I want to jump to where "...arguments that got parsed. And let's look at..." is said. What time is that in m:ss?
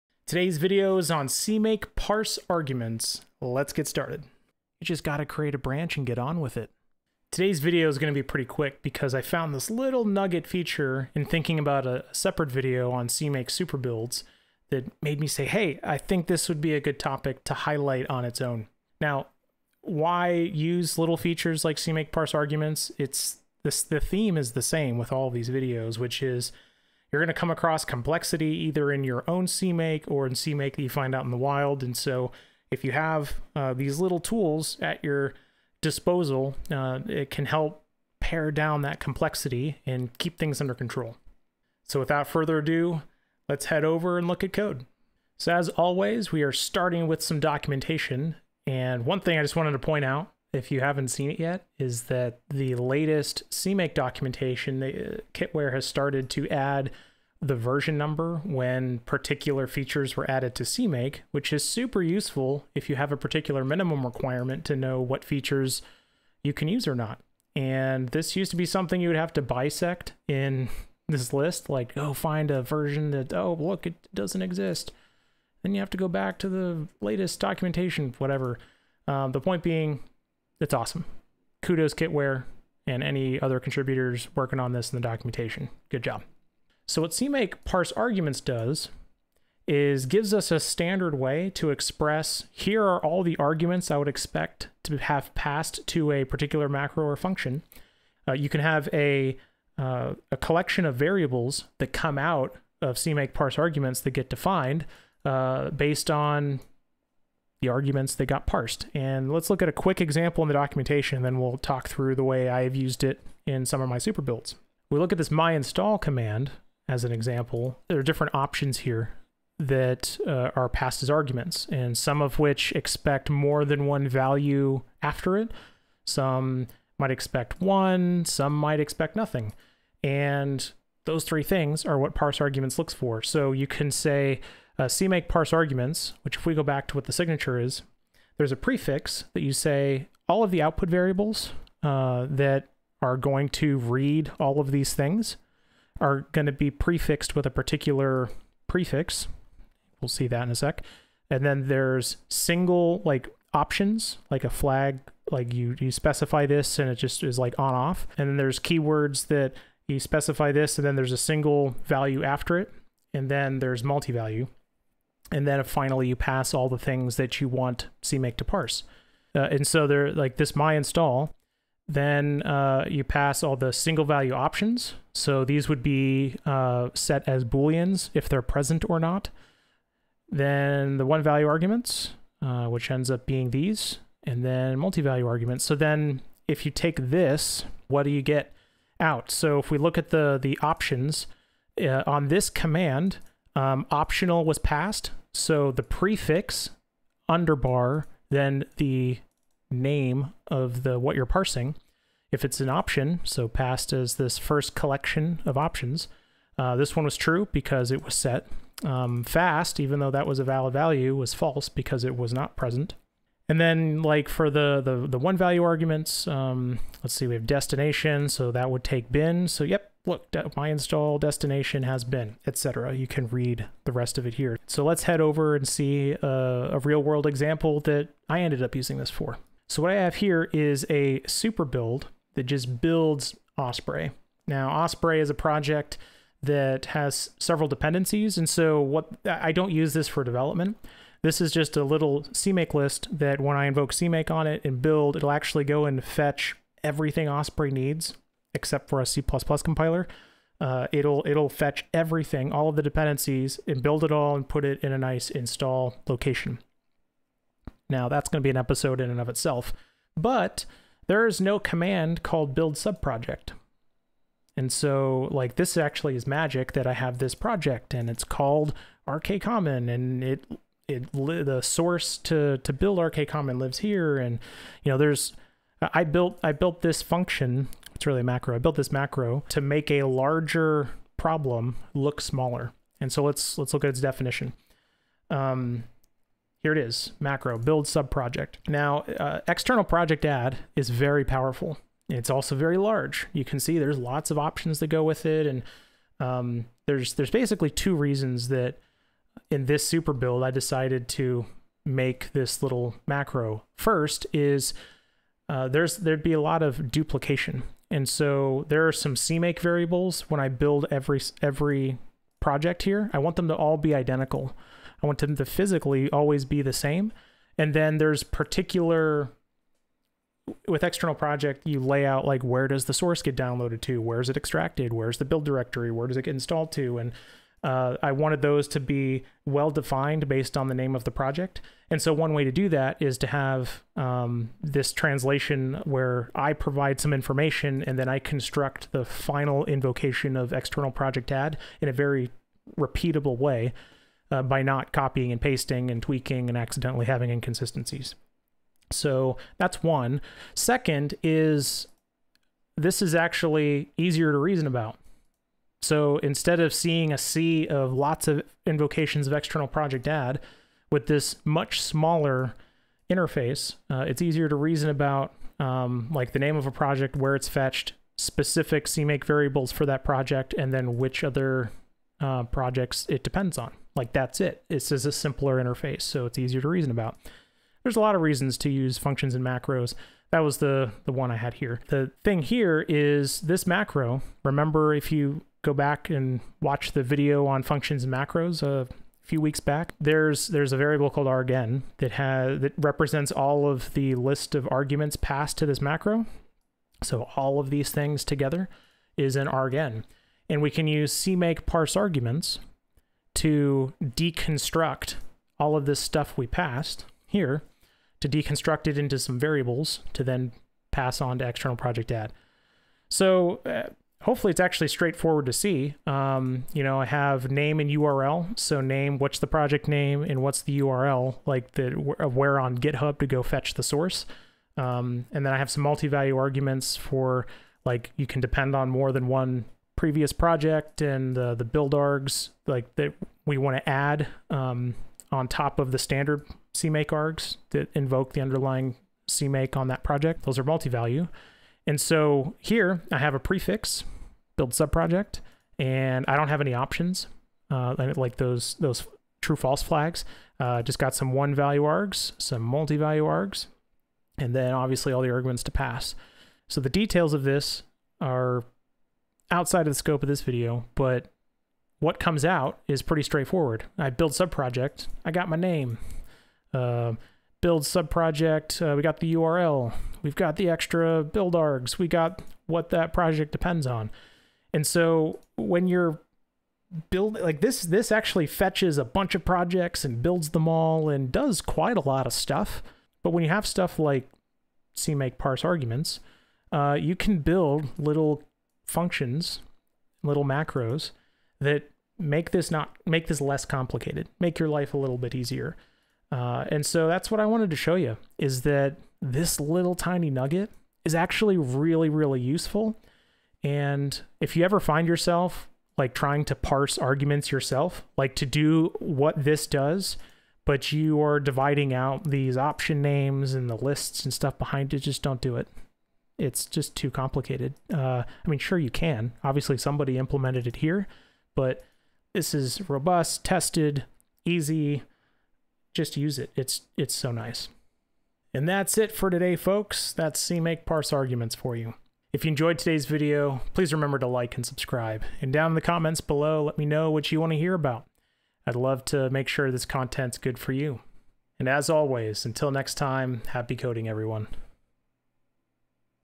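1:47.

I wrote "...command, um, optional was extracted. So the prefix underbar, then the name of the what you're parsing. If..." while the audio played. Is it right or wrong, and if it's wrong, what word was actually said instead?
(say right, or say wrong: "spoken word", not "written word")
wrong: "passed", not "extracted".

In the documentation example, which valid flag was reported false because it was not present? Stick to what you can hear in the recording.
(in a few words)
fast.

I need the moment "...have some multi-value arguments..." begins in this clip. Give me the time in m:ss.
7:05.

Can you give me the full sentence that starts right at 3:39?
So yep, look, my install destination has been, etc.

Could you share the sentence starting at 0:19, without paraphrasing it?
Now, why use little features like CMake parse arguments?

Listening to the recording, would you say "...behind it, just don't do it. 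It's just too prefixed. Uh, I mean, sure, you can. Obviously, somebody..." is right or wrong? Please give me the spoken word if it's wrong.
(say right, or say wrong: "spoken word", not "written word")
wrong: "complicated", not "prefixed".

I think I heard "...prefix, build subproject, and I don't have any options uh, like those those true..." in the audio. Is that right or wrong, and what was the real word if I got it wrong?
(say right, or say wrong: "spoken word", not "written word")
right.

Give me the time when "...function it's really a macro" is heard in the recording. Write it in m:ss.
4:37.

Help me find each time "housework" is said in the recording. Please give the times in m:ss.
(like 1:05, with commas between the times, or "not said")
not said.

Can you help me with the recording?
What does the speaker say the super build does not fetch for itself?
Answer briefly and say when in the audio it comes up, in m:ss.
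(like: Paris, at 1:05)
C++ compiler, at 4:09.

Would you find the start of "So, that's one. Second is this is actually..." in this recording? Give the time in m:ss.
5:48.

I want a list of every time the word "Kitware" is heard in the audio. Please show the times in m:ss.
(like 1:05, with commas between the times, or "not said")
0:55, 1:21.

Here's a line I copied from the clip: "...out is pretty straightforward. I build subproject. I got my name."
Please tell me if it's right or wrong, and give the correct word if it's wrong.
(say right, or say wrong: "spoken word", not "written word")
right.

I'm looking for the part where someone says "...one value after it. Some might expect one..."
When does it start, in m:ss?
2:03.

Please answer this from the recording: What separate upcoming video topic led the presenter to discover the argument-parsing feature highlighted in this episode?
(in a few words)
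CMake super builds.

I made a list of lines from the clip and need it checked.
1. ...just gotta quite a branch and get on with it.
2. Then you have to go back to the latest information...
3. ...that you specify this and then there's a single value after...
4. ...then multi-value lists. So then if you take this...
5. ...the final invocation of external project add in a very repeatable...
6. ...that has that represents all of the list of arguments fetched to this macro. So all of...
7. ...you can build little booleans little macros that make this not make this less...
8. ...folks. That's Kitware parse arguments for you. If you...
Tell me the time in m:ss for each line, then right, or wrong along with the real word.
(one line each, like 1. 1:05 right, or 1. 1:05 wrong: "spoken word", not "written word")
1. 0:04 wrong: "create", not "quite"
2. 1:15 wrong: "documentation", not "information"
3. 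2:39 right
4. 3:04 wrong: "arguments", not "lists"
5. 5:38 right
6. 6:31 wrong: "passed", not "fetched"
7. 8:06 wrong: "functions", not "booleans"
8. 8:49 wrong: "CMake", not "Kitware".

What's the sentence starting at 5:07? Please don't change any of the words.
And so there are some CMake variables when I build every, every project here.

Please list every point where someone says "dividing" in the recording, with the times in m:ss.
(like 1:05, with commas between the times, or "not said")
8:31.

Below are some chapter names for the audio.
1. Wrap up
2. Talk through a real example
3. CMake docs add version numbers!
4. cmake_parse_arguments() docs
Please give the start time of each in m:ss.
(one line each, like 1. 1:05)
1. 8:48
2. 3:49
3. 0:45
4. 1:26.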